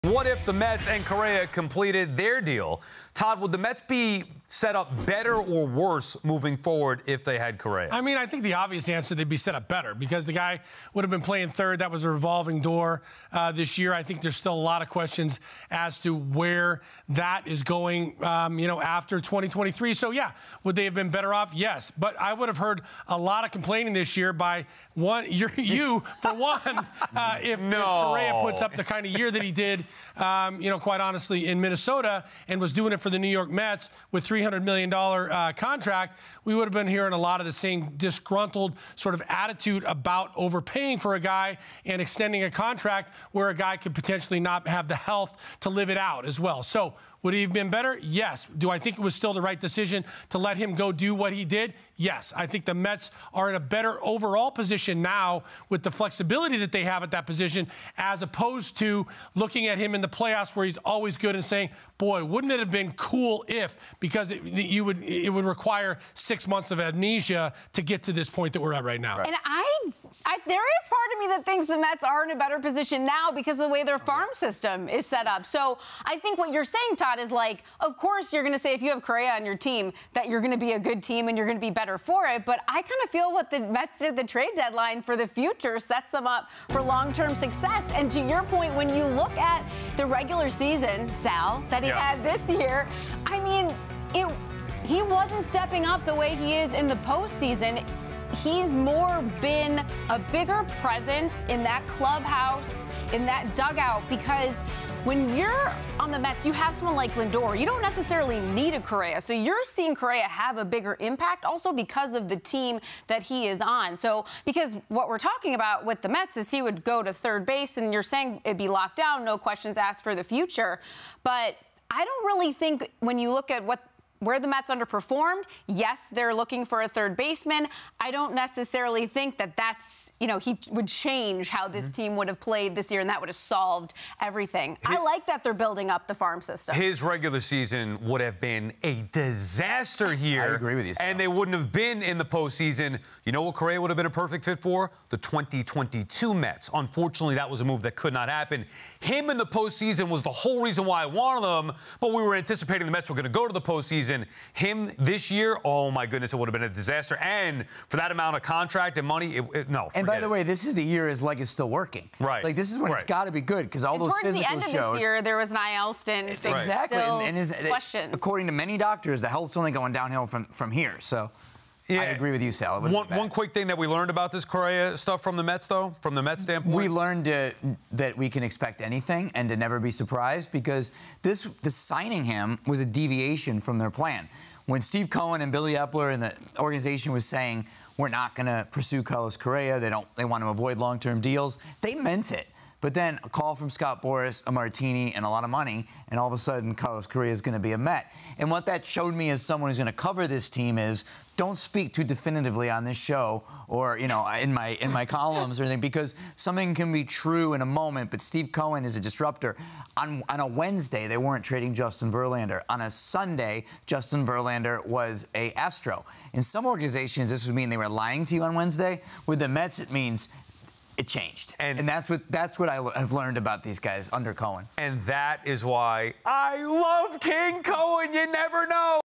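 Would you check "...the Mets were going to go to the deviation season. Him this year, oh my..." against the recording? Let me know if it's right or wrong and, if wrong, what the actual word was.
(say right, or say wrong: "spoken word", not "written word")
wrong: "postseason", not "deviation".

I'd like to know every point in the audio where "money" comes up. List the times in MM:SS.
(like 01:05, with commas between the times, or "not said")
02:39, 03:15.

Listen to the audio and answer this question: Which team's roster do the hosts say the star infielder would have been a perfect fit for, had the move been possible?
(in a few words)
The 2022 Mets.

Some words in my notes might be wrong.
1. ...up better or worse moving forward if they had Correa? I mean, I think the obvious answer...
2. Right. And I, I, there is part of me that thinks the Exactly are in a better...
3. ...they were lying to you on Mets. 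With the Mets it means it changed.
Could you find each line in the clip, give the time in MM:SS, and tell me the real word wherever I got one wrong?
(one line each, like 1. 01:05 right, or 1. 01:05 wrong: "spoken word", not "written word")
1. 00:04 right
2. 01:09 wrong: "Mets", not "Exactly"
3. 03:37 wrong: "Wednesday", not "Mets".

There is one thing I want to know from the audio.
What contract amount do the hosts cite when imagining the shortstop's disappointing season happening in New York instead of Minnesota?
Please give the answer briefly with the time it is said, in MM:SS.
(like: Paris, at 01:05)
$300 million, at 00:34.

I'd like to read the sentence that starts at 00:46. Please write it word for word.
So would he have been better?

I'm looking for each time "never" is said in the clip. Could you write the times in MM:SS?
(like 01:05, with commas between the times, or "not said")
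02:59, 03:48.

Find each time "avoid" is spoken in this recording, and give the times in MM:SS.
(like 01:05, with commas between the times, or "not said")
03:10.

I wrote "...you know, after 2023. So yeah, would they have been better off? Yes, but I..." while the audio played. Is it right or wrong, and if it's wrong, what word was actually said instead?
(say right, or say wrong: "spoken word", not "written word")
right.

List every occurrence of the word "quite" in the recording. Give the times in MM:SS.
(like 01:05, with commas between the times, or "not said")
00:30.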